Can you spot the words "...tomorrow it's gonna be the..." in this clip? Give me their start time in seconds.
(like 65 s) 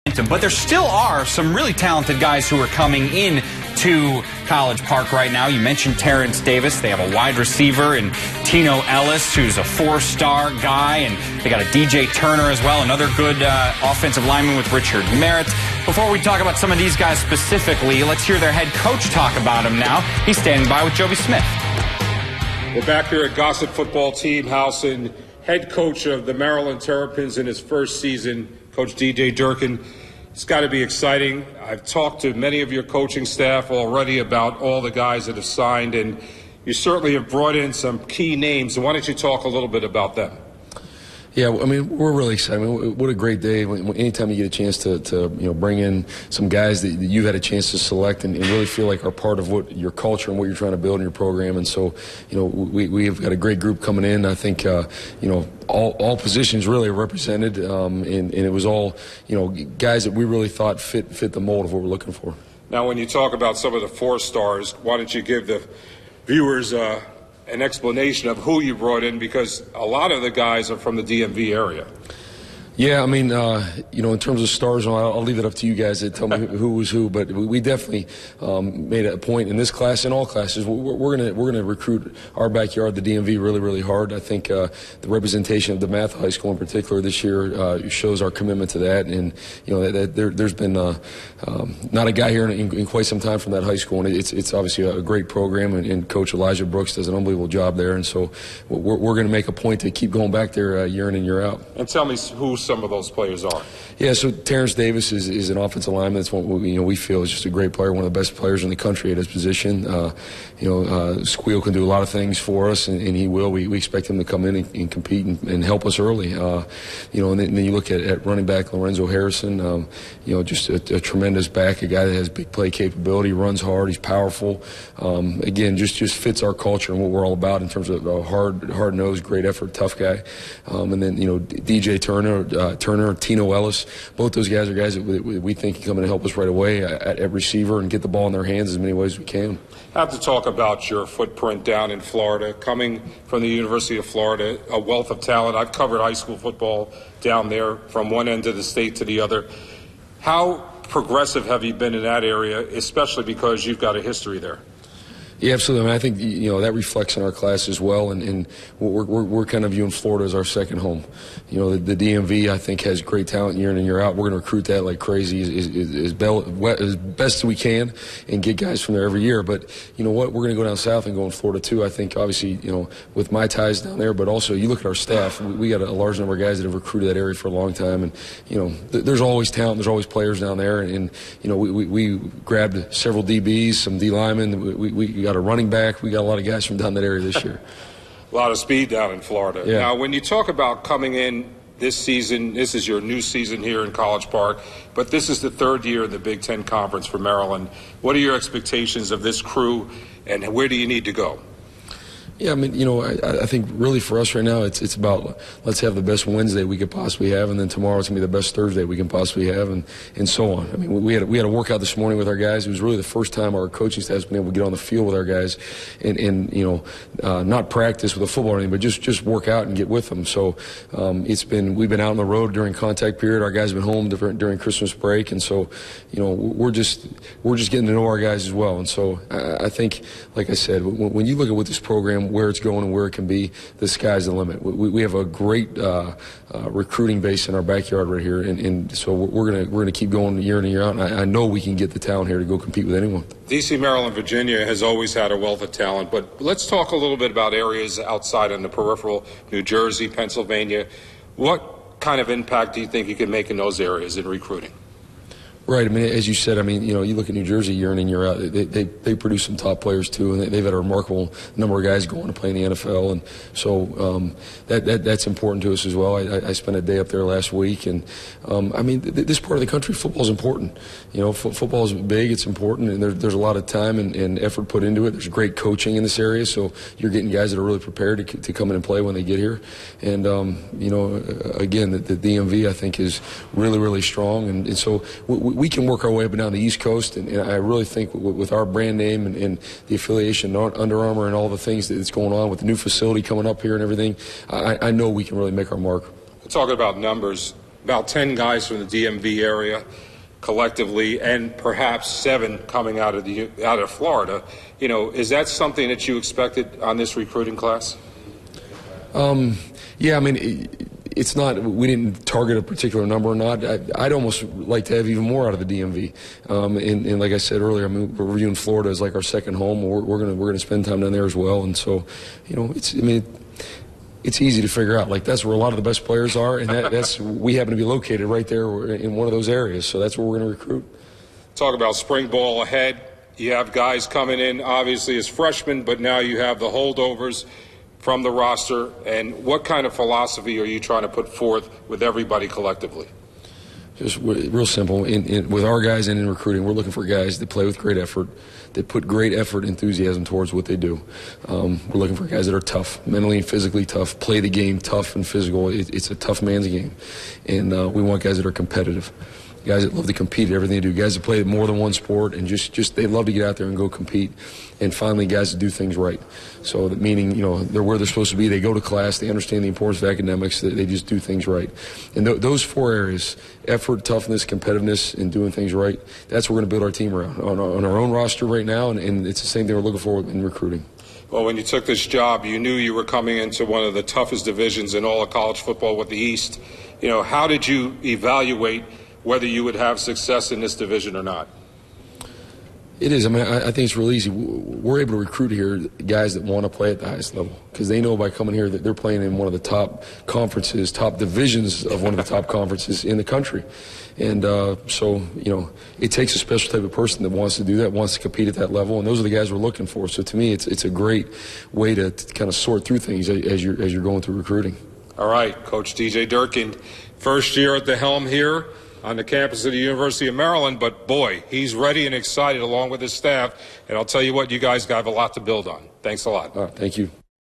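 207 s.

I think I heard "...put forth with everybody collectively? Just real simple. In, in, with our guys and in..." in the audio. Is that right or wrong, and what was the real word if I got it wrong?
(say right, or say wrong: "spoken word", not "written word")
right.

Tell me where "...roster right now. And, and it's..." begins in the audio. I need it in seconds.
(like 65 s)
378 s.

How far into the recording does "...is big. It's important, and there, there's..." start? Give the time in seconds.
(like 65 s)
271 s.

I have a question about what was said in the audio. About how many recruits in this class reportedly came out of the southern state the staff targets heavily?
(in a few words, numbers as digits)
7.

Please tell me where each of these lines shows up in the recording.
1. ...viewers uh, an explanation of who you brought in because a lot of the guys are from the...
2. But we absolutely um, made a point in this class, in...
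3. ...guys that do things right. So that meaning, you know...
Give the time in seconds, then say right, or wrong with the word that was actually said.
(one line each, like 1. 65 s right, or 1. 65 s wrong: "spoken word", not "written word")
1. 66 s right
2. 77 s wrong: "definitely", not "absolutely"
3. 365 s right.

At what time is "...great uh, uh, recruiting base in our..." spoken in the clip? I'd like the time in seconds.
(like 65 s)
235 s.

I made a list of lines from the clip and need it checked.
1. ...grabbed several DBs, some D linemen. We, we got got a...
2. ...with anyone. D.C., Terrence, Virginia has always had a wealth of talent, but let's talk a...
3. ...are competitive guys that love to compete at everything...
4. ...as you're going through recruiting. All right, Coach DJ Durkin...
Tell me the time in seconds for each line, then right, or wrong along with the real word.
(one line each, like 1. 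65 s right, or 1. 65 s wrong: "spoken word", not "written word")
1. 182 s right
2. 242 s wrong: "Maryland", not "Terrence"
3. 358 s right
4. 413 s right.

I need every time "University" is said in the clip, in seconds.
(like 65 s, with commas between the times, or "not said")
143 s, 419 s.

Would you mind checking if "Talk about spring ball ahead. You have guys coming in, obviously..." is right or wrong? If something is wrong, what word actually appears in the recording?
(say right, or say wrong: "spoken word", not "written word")
right.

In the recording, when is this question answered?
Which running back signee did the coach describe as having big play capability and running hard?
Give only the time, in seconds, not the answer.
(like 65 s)
118 s.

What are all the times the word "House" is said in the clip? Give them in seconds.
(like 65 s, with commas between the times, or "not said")
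24 s.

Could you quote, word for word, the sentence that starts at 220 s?
So um, it's been we've been out on the road during contact period.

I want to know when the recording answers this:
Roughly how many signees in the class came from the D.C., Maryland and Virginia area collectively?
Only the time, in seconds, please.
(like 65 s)
298 s.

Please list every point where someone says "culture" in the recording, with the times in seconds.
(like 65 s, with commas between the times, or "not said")
49 s, 126 s.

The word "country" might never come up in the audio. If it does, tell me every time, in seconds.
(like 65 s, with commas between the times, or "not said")
108 s, 269 s, 403 s.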